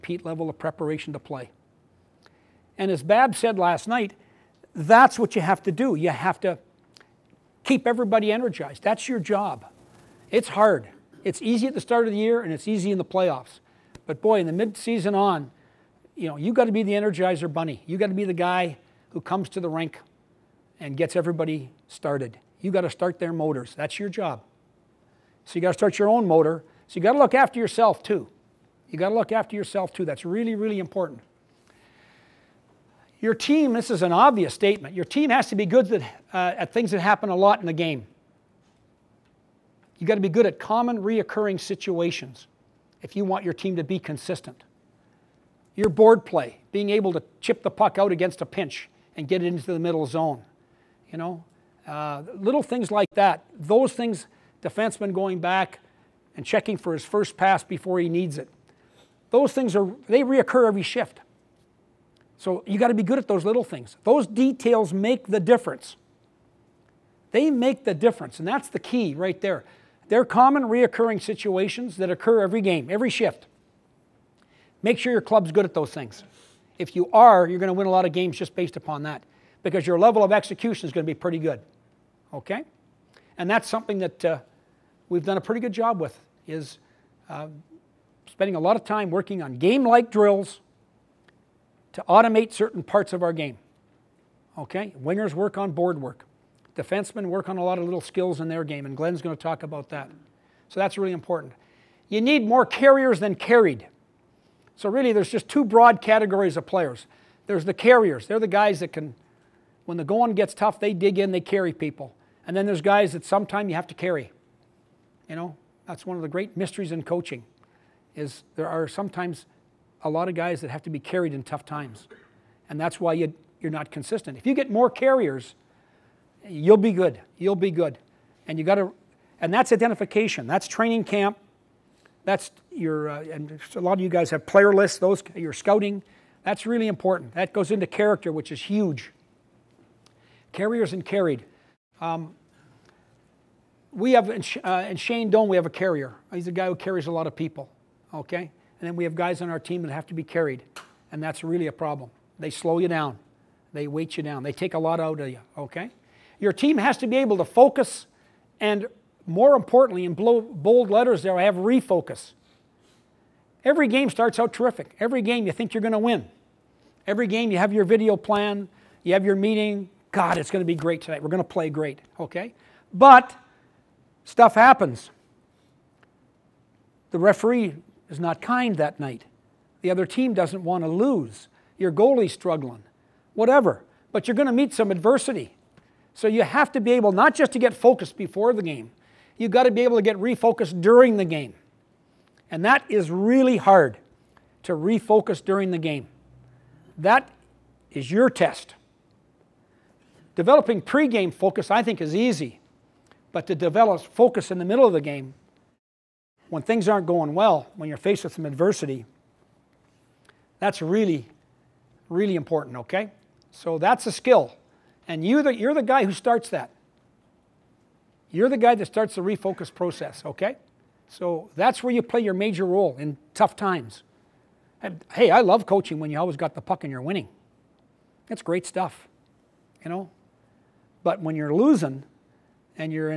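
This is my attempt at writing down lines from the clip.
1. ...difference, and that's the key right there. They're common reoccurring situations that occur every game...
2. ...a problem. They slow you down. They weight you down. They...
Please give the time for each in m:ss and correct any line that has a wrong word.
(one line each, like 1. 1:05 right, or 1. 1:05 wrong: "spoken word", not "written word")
1. 1:07 right
2. 2:31 right.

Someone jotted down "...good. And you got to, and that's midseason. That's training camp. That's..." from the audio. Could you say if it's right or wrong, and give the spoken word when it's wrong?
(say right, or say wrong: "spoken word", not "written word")
wrong: "identification", not "midseason".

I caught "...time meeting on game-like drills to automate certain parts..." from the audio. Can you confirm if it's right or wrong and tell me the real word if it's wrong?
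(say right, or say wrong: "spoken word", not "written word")
wrong: "working", not "meeting".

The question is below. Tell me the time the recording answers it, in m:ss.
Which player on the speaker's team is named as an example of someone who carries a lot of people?
2:24.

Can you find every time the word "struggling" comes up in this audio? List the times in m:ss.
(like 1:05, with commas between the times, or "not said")
3:02.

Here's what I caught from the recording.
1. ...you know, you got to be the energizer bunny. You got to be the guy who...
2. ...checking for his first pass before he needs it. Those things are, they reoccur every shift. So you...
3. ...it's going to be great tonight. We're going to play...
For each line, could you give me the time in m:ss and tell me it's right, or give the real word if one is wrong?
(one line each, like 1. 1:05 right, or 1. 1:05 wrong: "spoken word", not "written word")
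1. 0:16 right
2. 0:56 right
3. 2:50 right.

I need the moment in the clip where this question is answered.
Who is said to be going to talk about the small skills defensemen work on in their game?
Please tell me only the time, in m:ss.
1:38.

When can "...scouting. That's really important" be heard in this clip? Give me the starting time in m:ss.
2:15.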